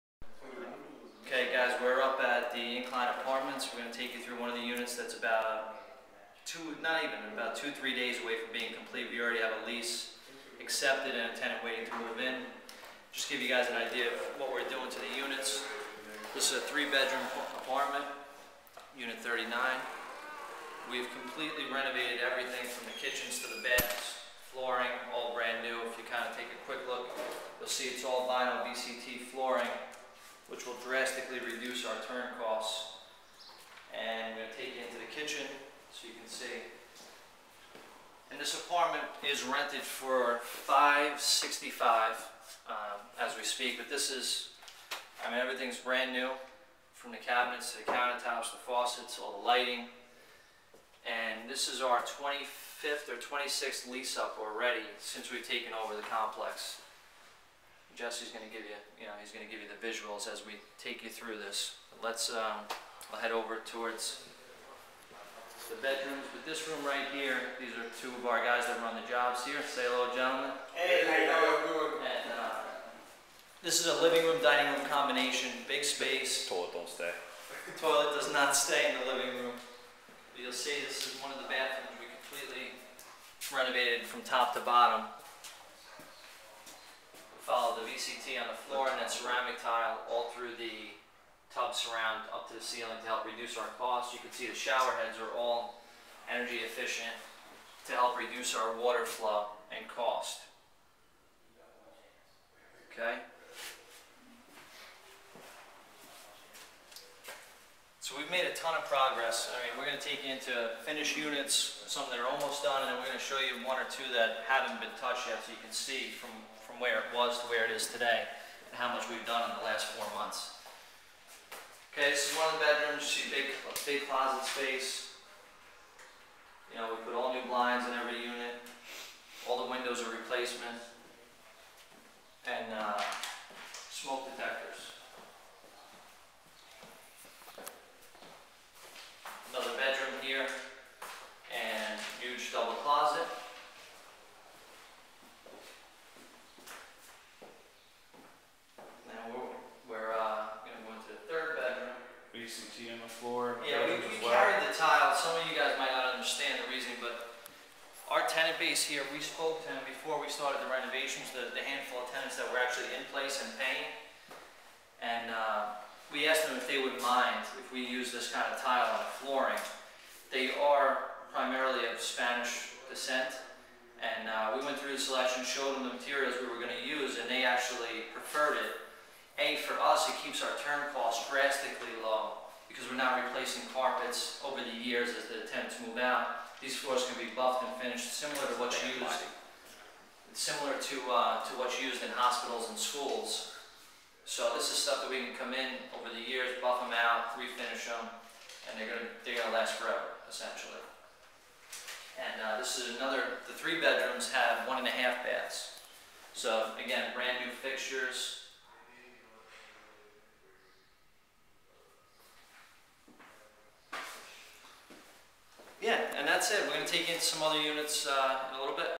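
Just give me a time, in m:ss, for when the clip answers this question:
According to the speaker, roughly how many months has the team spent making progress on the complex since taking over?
1:59.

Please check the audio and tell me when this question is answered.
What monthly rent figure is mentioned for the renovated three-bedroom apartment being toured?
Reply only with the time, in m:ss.
0:40.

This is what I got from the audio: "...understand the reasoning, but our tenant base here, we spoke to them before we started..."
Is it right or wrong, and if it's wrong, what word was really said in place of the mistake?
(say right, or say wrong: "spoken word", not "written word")
right.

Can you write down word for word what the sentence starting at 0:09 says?
We already have a lease accepted and a tenant waiting to move in.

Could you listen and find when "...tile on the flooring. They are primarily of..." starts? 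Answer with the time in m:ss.
2:48.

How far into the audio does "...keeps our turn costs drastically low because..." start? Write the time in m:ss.
3:00.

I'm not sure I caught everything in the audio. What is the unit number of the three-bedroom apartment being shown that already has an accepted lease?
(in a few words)
39.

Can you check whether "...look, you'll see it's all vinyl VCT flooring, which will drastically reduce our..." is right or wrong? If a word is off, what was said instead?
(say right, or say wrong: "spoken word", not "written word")
right.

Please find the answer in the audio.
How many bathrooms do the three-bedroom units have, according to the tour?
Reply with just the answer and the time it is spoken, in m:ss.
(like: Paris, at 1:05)
1.5, at 3:24.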